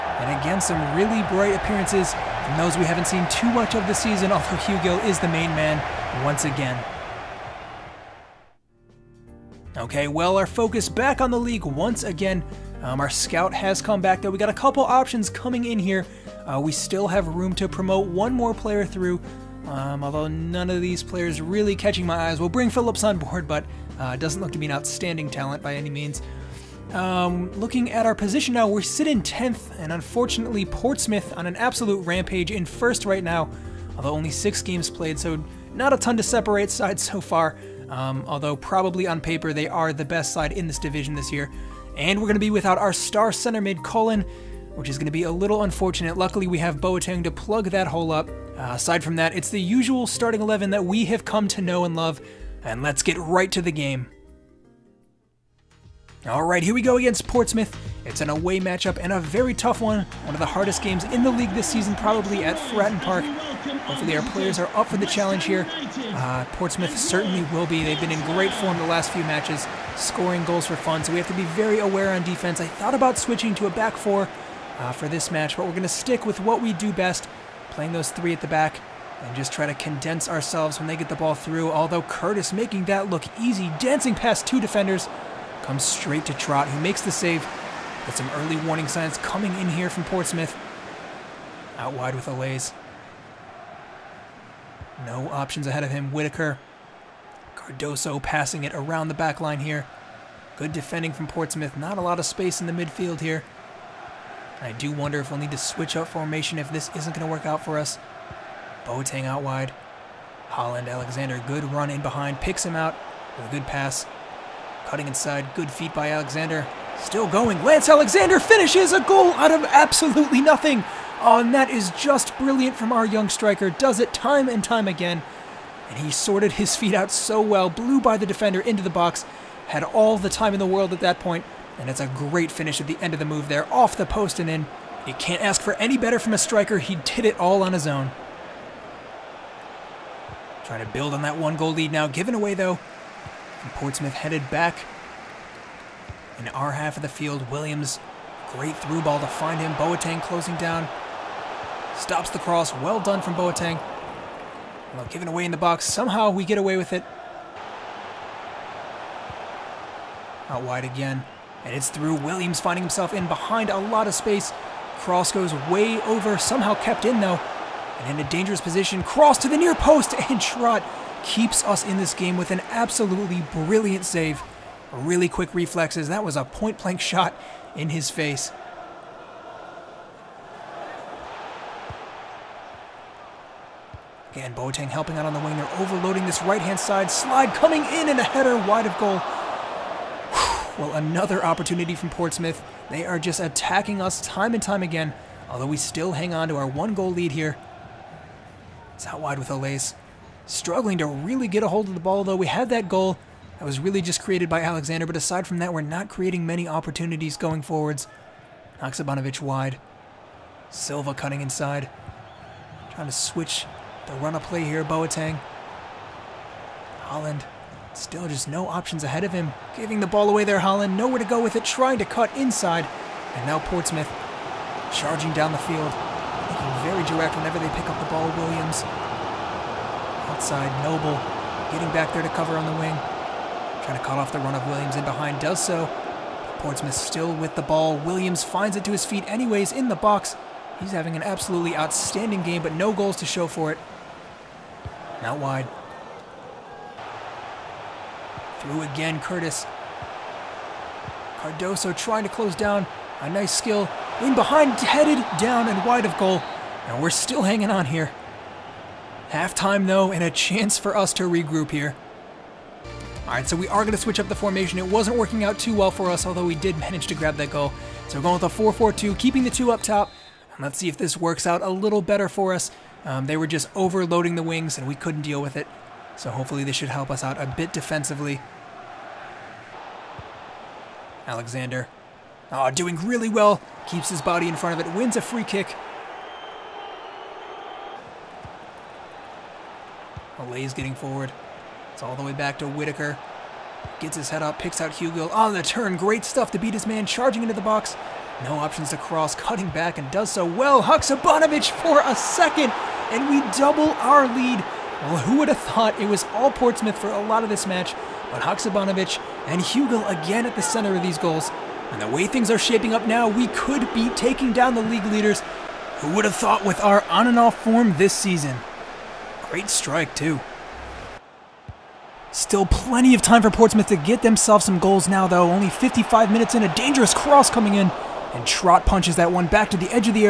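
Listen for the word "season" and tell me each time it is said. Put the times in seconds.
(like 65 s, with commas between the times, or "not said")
4 s, 61 s, 318 s.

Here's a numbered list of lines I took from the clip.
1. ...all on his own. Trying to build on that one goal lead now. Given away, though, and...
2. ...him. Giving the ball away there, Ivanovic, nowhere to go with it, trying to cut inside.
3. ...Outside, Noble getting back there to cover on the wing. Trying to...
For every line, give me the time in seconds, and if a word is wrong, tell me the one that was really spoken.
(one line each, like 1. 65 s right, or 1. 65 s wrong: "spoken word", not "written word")
1. 137 s right
2. 219 s wrong: "Holland", not "Ivanovic"
3. 230 s right.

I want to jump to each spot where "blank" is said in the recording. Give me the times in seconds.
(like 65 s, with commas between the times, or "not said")
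176 s.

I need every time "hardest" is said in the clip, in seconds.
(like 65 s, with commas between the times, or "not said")
60 s.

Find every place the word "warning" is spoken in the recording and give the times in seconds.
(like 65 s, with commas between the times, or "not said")
88 s.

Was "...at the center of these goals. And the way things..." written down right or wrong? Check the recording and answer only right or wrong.
right.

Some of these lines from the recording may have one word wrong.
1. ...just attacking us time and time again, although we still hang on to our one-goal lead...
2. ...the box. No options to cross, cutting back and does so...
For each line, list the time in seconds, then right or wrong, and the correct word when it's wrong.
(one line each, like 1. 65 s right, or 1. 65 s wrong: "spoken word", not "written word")
1. 193 s right
2. 297 s right.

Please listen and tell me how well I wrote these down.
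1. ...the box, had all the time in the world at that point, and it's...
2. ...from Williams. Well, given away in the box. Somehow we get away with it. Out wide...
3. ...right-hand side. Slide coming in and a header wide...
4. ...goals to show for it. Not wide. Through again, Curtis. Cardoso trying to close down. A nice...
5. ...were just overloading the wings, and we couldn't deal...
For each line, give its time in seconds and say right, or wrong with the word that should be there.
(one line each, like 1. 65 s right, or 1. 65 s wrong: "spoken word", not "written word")
1. 128 s right
2. 153 s wrong: "Boateng", not "Williams"
3. 186 s right
4. 242 s right
5. 273 s right.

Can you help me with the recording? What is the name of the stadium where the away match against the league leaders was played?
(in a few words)
Fratton Park.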